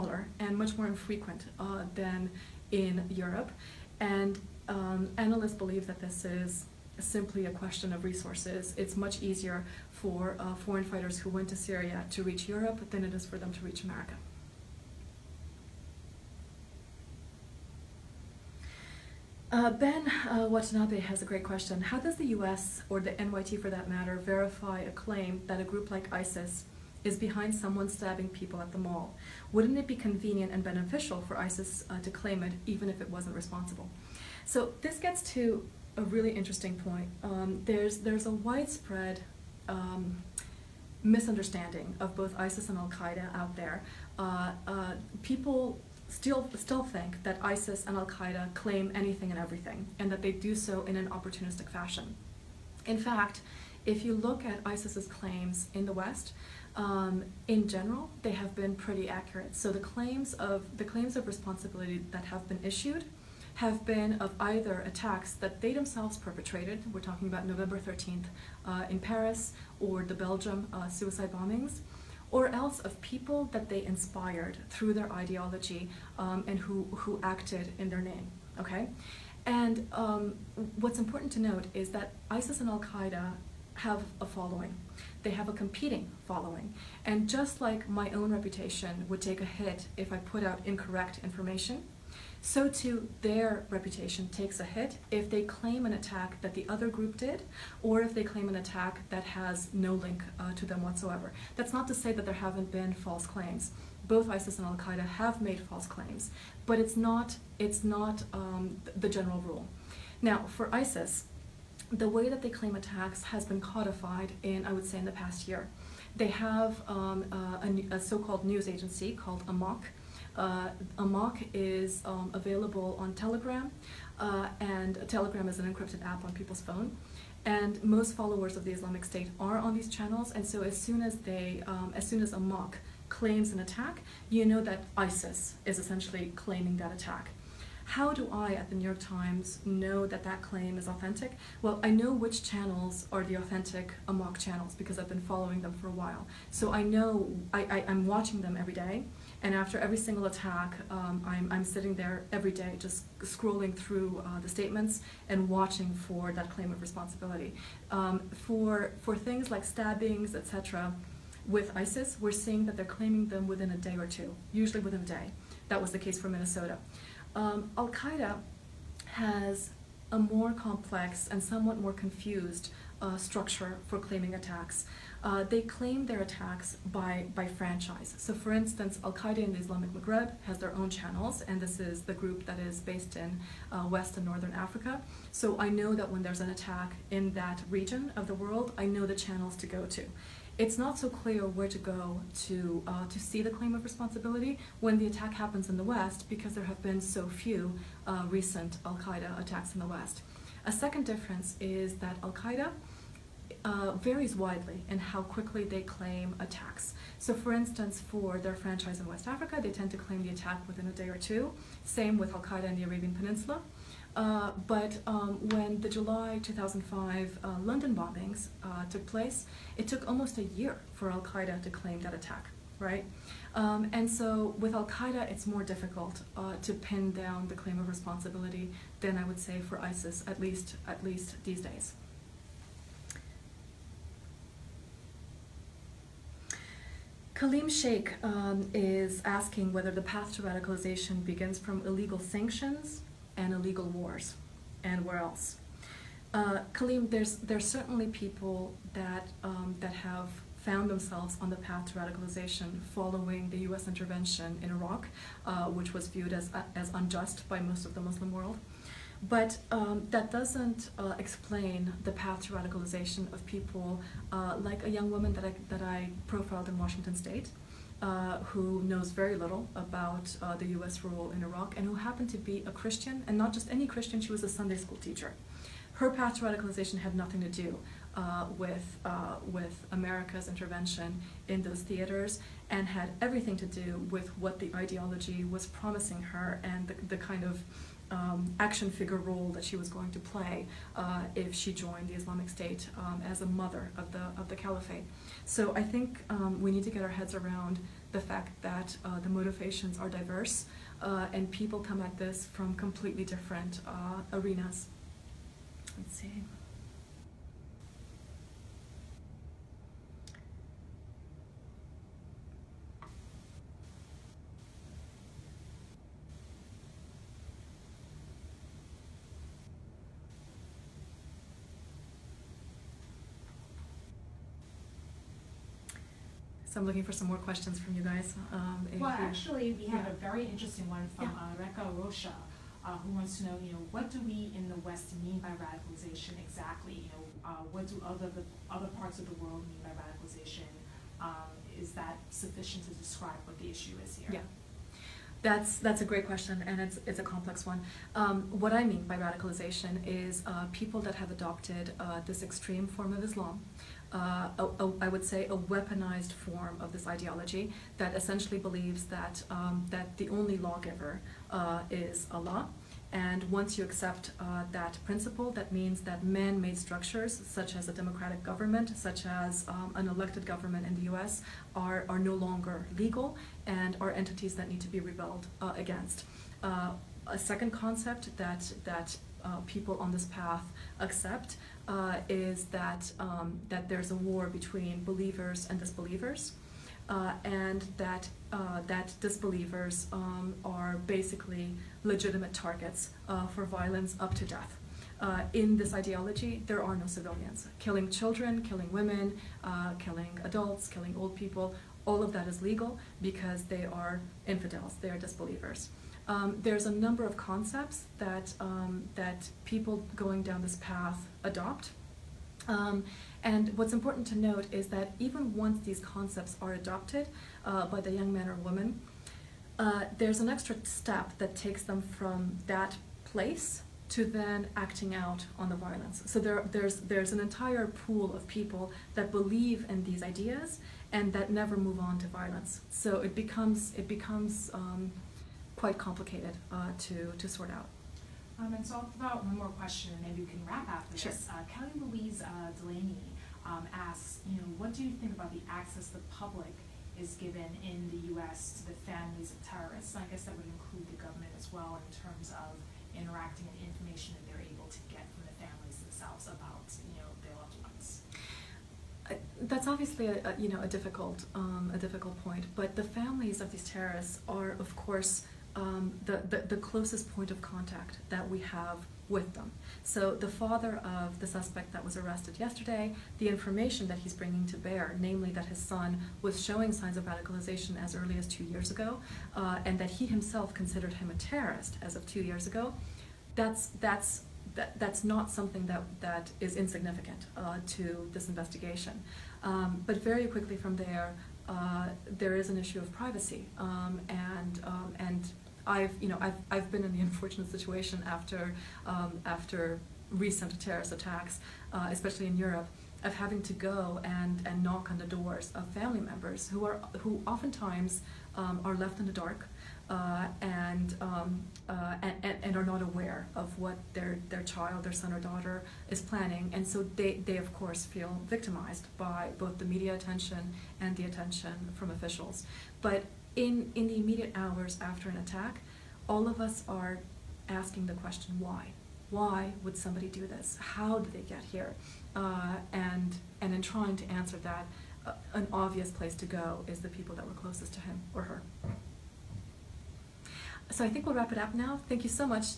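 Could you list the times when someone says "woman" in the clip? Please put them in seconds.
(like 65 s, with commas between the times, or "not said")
265 s, 418 s.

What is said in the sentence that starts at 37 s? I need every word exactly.
Um, there's, there's a widespread um, misunderstanding of both ISIS and Al-Qaeda out there.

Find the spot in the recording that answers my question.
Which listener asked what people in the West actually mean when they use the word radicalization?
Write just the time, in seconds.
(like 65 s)
331 s.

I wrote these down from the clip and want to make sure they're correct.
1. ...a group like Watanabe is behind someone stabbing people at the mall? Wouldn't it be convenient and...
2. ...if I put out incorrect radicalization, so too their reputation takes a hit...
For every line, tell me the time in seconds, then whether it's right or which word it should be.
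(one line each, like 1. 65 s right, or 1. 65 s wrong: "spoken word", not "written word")
1. 25 s wrong: "ISIS", not "Watanabe"
2. 89 s wrong: "information", not "radicalization".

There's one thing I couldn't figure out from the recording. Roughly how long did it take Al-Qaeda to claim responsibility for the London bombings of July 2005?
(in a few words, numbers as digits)
almost a year.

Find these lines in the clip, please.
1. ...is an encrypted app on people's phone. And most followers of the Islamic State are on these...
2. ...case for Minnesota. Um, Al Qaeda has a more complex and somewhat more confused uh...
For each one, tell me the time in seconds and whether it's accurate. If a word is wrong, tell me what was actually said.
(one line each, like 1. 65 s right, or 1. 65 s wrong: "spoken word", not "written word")
1. 125 s right
2. 165 s right.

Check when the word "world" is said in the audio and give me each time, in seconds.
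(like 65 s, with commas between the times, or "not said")
188 s, 258 s, 339 s.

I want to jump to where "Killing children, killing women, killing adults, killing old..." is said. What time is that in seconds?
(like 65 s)
397 s.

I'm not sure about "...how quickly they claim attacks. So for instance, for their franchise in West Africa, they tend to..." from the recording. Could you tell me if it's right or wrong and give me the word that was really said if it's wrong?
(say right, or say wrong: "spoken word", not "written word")
right.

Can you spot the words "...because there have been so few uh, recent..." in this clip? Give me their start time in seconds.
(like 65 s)
196 s.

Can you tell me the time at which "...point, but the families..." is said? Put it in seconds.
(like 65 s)
462 s.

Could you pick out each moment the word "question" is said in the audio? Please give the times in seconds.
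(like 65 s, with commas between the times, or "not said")
7 s, 21 s, 327 s, 346 s, 439 s, 528 s.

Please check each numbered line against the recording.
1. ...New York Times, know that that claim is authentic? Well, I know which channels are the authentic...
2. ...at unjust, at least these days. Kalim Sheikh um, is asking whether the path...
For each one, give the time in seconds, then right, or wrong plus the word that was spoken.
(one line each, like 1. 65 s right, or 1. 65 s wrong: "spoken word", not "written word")
1. 138 s right
2. 230 s wrong: "least", not "unjust".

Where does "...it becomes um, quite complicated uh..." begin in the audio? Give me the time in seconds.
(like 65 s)
433 s.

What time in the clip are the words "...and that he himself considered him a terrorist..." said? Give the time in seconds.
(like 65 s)
479 s.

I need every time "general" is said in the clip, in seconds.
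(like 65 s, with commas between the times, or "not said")
57 s, 109 s.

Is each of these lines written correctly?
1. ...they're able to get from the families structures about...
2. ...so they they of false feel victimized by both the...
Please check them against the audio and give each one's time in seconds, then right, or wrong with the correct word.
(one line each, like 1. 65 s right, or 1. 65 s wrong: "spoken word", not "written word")
1. 454 s wrong: "themselves", not "structures"
2. 516 s wrong: "course", not "false".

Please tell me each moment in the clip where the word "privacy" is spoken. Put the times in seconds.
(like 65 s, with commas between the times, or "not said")
493 s.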